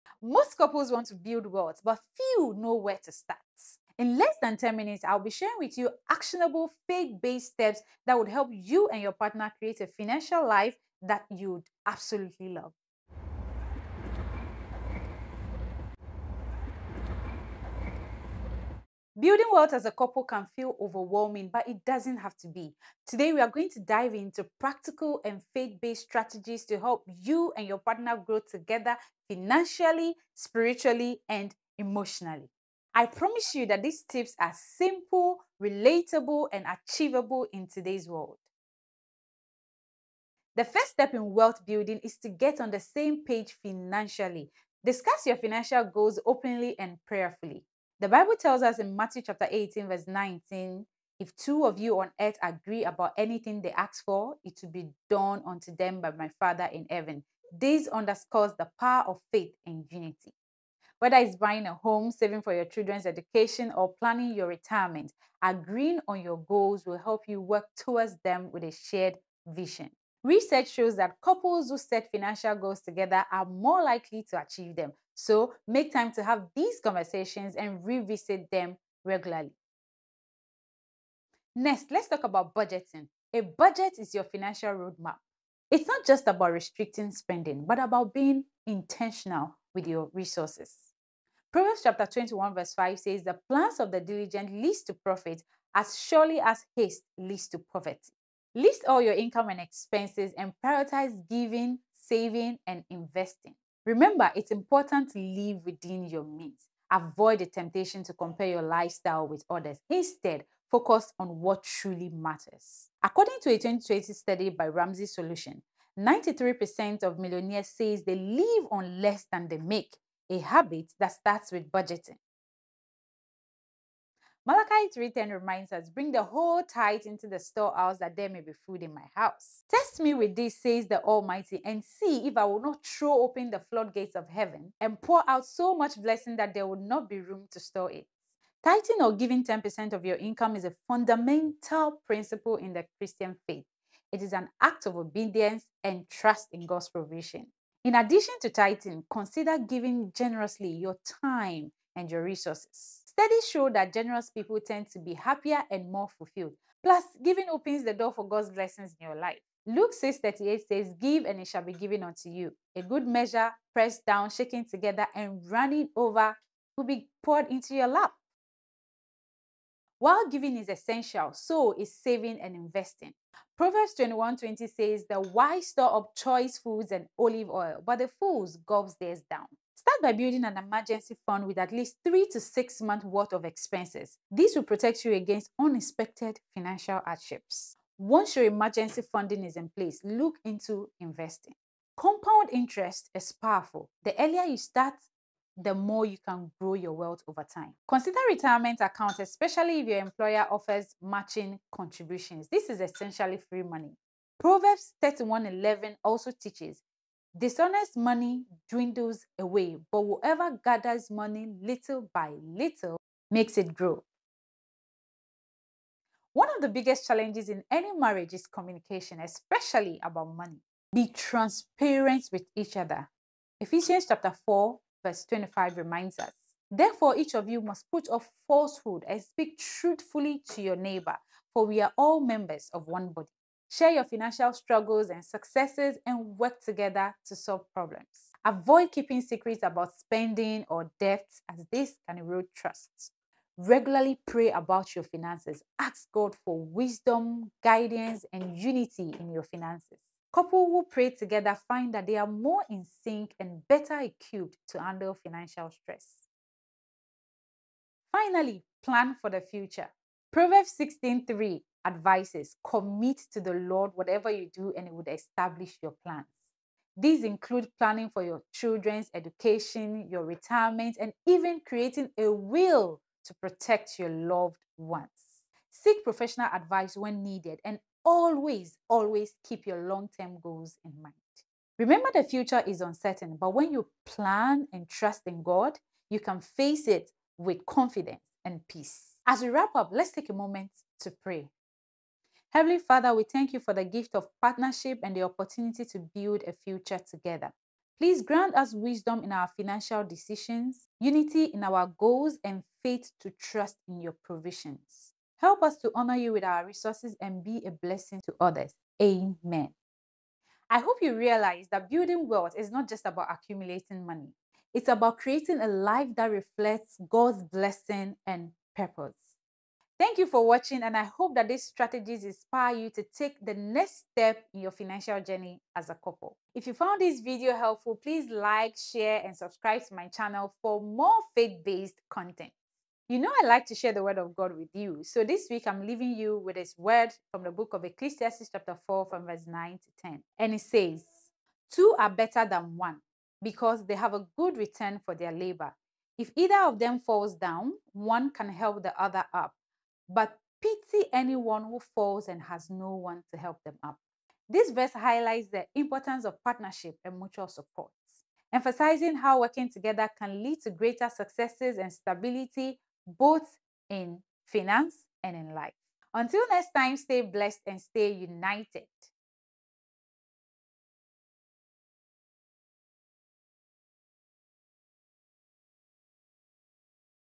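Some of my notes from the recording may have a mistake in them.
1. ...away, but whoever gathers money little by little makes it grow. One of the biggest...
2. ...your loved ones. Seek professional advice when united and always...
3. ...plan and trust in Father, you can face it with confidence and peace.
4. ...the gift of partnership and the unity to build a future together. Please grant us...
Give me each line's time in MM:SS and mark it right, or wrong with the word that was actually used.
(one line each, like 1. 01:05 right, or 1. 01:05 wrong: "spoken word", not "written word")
1. 03:29 right
2. 04:33 wrong: "needed", not "united"
3. 04:44 wrong: "God", not "Father"
4. 04:53 wrong: "opportunity", not "unity".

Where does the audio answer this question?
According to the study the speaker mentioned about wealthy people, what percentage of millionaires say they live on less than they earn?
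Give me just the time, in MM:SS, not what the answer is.
01:55.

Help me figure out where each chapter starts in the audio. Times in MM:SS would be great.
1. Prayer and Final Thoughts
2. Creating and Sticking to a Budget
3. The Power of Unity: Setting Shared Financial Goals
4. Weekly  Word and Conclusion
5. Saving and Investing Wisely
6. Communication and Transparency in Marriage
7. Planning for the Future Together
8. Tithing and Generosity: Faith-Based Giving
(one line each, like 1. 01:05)
1. 04:52
2. 01:20
3. 00:39
4. 05:33
5. 02:49
6. 03:35
7. 04:17
8. 02:03.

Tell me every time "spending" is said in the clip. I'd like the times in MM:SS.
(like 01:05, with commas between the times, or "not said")
01:27, 03:59.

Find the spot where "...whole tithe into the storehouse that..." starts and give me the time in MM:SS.
02:06.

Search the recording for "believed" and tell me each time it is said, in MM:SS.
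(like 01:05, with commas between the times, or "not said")
not said.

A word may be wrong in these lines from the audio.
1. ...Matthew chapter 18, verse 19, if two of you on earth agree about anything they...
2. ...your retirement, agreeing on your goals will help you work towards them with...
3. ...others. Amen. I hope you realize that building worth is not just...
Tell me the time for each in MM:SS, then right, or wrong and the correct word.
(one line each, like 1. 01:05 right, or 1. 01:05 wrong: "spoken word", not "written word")
1. 00:48 right
2. 01:04 right
3. 05:08 wrong: "wealth", not "worth".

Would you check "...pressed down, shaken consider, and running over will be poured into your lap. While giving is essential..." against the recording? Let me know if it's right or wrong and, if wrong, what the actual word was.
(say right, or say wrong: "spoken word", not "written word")
wrong: "together", not "consider".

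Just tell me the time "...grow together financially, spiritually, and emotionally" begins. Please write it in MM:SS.
00:28.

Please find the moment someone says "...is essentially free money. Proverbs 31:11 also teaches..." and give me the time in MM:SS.
03:22.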